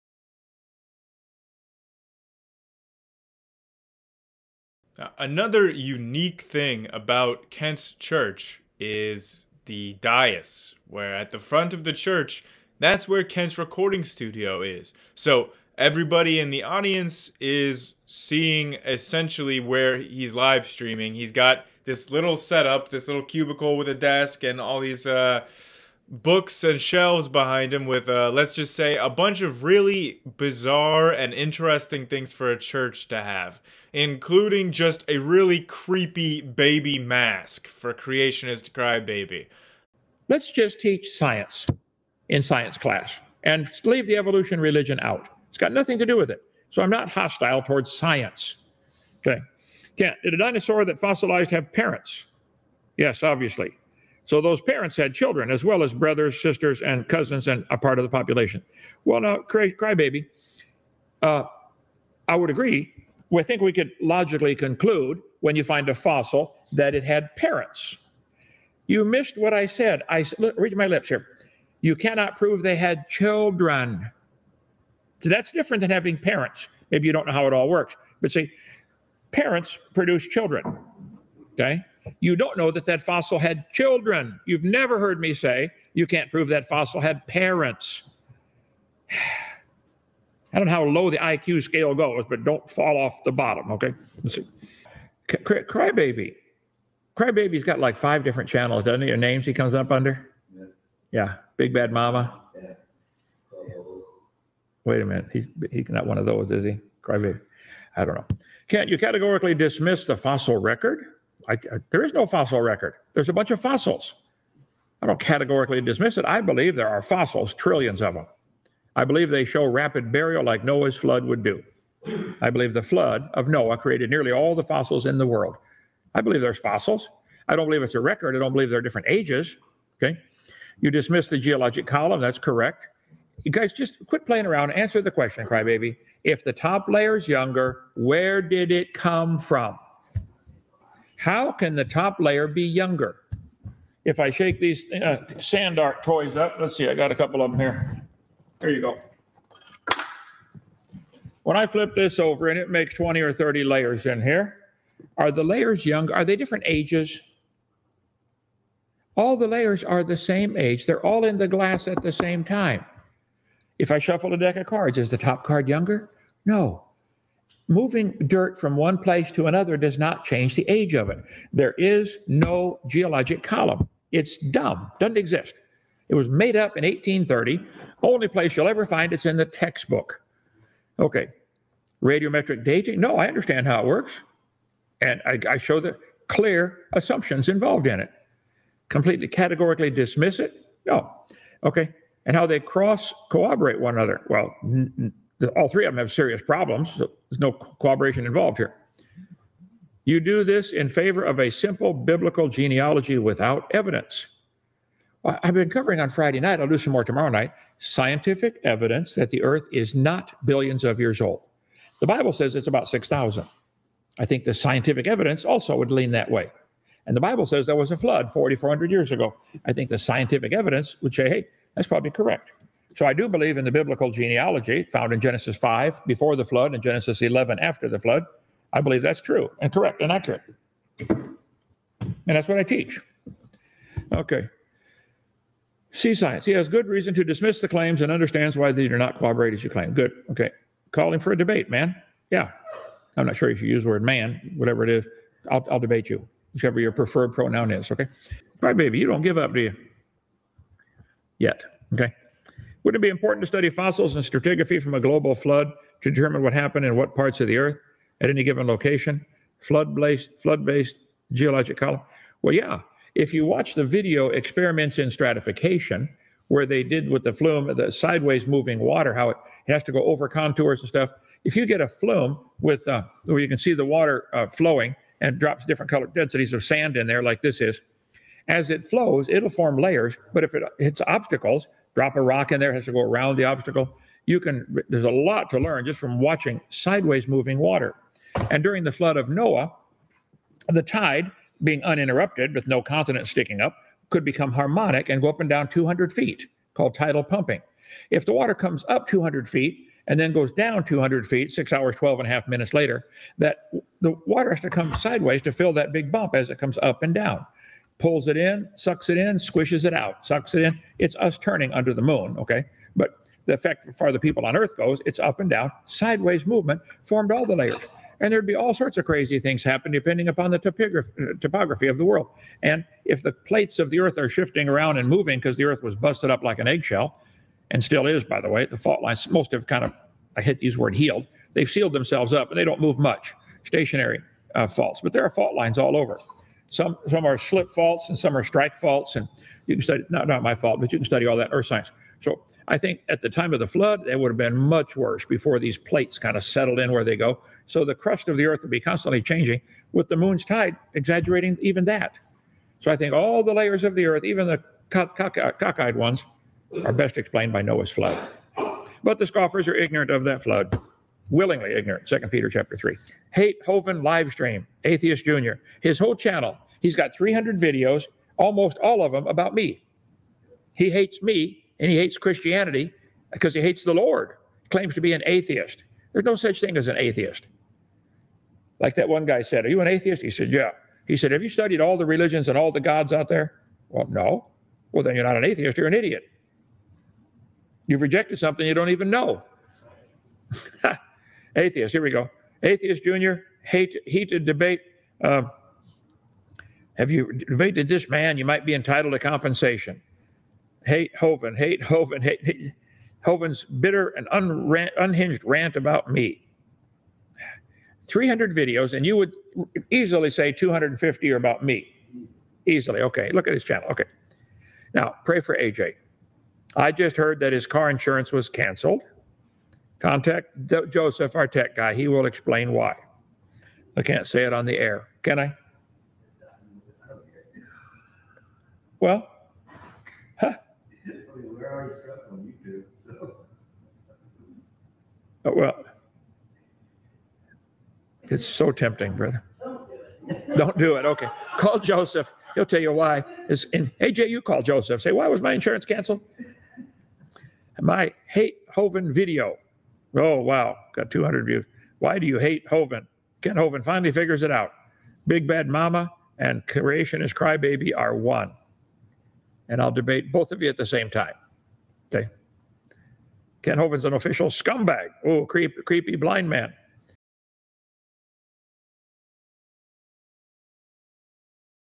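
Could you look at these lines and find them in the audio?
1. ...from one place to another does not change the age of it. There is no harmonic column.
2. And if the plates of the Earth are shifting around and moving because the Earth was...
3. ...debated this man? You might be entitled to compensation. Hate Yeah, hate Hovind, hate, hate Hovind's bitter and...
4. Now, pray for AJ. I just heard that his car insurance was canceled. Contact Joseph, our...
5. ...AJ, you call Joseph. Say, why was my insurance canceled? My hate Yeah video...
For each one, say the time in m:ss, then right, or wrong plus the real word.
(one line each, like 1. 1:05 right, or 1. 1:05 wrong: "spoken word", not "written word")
1. 2:48 wrong: "geologic", not "harmonic"
2. 5:22 right
3. 6:37 wrong: "Hovind", not "Yeah"
4. 6:54 right
5. 7:24 wrong: "Hovind", not "Yeah".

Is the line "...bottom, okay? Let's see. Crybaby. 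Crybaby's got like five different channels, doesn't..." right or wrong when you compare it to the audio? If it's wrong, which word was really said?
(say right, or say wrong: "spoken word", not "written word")
right.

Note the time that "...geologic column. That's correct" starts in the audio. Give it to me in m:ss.
2:11.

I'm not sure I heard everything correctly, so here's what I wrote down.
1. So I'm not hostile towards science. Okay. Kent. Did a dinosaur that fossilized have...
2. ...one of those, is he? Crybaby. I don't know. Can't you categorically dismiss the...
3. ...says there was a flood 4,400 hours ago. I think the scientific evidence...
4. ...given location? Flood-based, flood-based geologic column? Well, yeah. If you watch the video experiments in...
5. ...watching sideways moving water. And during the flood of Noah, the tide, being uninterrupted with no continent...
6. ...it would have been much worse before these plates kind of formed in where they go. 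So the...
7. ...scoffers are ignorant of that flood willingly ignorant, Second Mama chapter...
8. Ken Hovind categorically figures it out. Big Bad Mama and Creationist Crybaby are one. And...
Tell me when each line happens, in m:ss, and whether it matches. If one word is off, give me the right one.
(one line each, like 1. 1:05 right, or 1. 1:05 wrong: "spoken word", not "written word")
1. 0:46 right
2. 1:46 right
3. 3:37 wrong: "years", not "hours"
4. 4:18 right
5. 4:46 right
6. 5:44 wrong: "settled", not "formed"
7. 5:59 wrong: "Peter", not "Mama"
8. 7:33 wrong: "finally", not "categorically".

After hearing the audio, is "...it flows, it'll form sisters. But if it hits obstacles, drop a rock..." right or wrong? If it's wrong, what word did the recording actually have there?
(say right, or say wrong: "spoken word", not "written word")
wrong: "layers", not "sisters".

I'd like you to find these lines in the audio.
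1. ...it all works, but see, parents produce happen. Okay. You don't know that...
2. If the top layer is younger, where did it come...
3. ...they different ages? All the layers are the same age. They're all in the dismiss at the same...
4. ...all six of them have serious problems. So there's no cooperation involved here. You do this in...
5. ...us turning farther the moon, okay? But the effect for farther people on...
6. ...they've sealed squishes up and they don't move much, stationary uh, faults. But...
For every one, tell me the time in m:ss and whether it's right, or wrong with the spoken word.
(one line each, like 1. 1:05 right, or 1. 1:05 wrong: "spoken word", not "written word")
1. 1:17 wrong: "children", not "happen"
2. 2:16 right
3. 2:36 wrong: "glass", not "dismiss"
4. 3:15 wrong: "three", not "six"
5. 5:11 wrong: "under", not "farther"
6. 5:31 wrong: "themselves", not "squishes".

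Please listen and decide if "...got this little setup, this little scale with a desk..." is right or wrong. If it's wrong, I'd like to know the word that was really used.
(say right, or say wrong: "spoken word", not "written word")
wrong: "cubicle", not "scale".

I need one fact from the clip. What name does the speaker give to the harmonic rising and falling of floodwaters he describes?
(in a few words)
tidal pumping.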